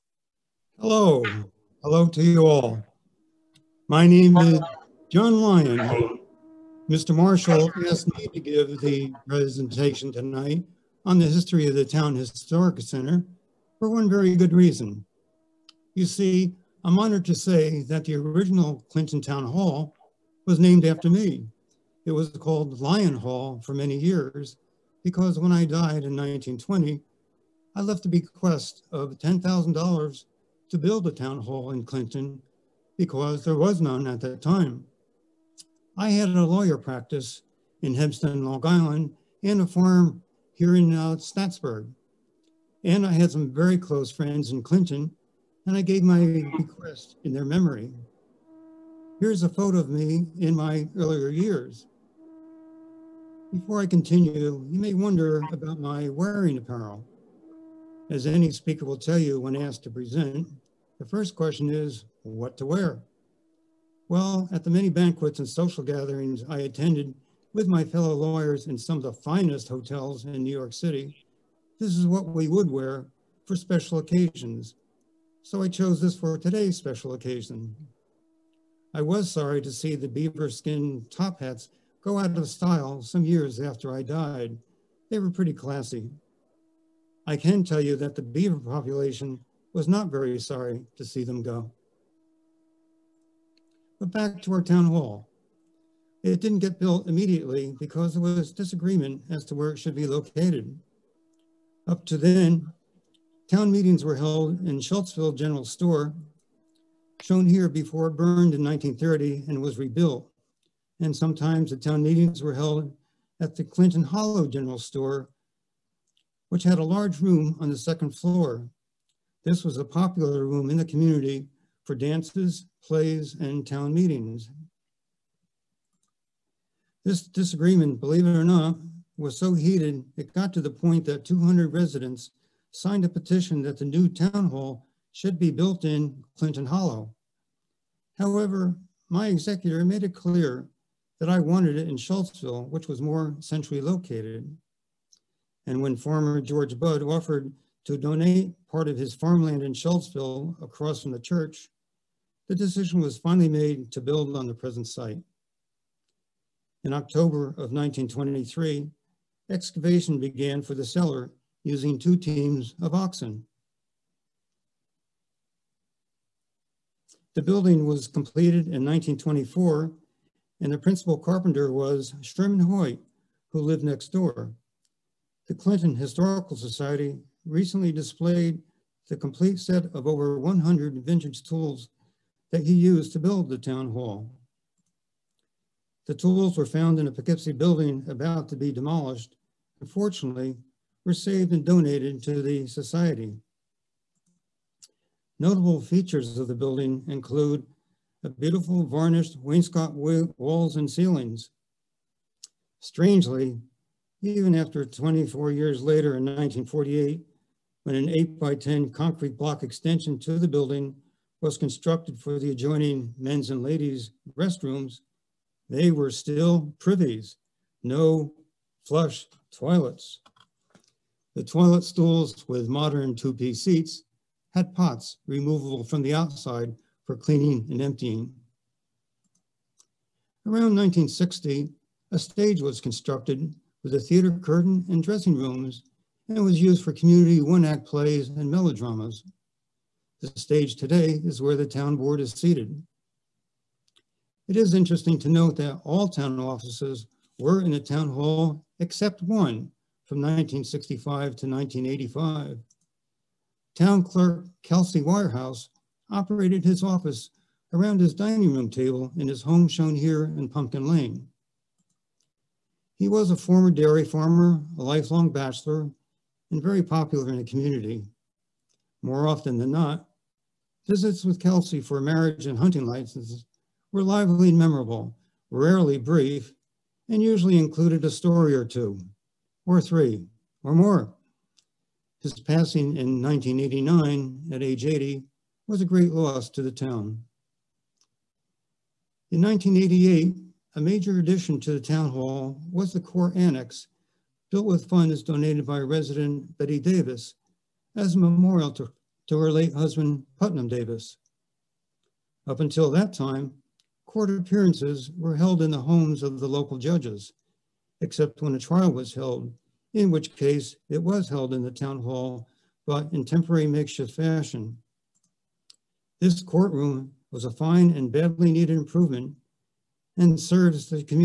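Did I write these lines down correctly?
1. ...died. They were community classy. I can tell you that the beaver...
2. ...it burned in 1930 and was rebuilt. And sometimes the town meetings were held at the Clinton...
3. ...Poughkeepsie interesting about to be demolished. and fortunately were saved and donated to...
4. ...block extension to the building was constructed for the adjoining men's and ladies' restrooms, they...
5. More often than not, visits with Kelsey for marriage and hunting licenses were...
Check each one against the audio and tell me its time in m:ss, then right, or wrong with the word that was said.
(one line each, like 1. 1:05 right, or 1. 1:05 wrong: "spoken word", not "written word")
1. 1:24 wrong: "pretty", not "community"
2. 1:48 right
3. 3:07 wrong: "building", not "interesting"
4. 3:29 right
5. 4:29 right.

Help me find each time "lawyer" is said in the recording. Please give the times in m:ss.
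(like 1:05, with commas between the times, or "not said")
0:36, 1:08.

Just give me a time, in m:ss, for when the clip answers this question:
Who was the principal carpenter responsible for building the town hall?
2:52.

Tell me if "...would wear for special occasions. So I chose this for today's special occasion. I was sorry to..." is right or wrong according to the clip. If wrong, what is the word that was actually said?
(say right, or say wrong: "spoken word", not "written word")
right.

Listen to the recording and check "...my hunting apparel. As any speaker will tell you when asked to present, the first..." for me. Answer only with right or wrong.
wrong.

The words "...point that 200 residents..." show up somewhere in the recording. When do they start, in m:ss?
2:10.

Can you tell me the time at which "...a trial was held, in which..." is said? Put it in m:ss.
5:08.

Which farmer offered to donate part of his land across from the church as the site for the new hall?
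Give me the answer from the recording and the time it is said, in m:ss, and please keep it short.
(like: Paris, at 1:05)
George Budd, at 2:26.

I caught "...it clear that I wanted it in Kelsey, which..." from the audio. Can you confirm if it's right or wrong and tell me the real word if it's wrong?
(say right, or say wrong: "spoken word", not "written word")
wrong: "Schultzville", not "Kelsey".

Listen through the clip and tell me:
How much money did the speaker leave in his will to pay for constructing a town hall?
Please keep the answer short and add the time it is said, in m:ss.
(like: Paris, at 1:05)
$10,000, at 0:29.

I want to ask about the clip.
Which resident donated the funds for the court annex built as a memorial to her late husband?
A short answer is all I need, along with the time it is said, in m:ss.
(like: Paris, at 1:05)
Betty Davis, at 4:56.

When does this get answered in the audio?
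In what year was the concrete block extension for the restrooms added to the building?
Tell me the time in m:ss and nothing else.
3:26.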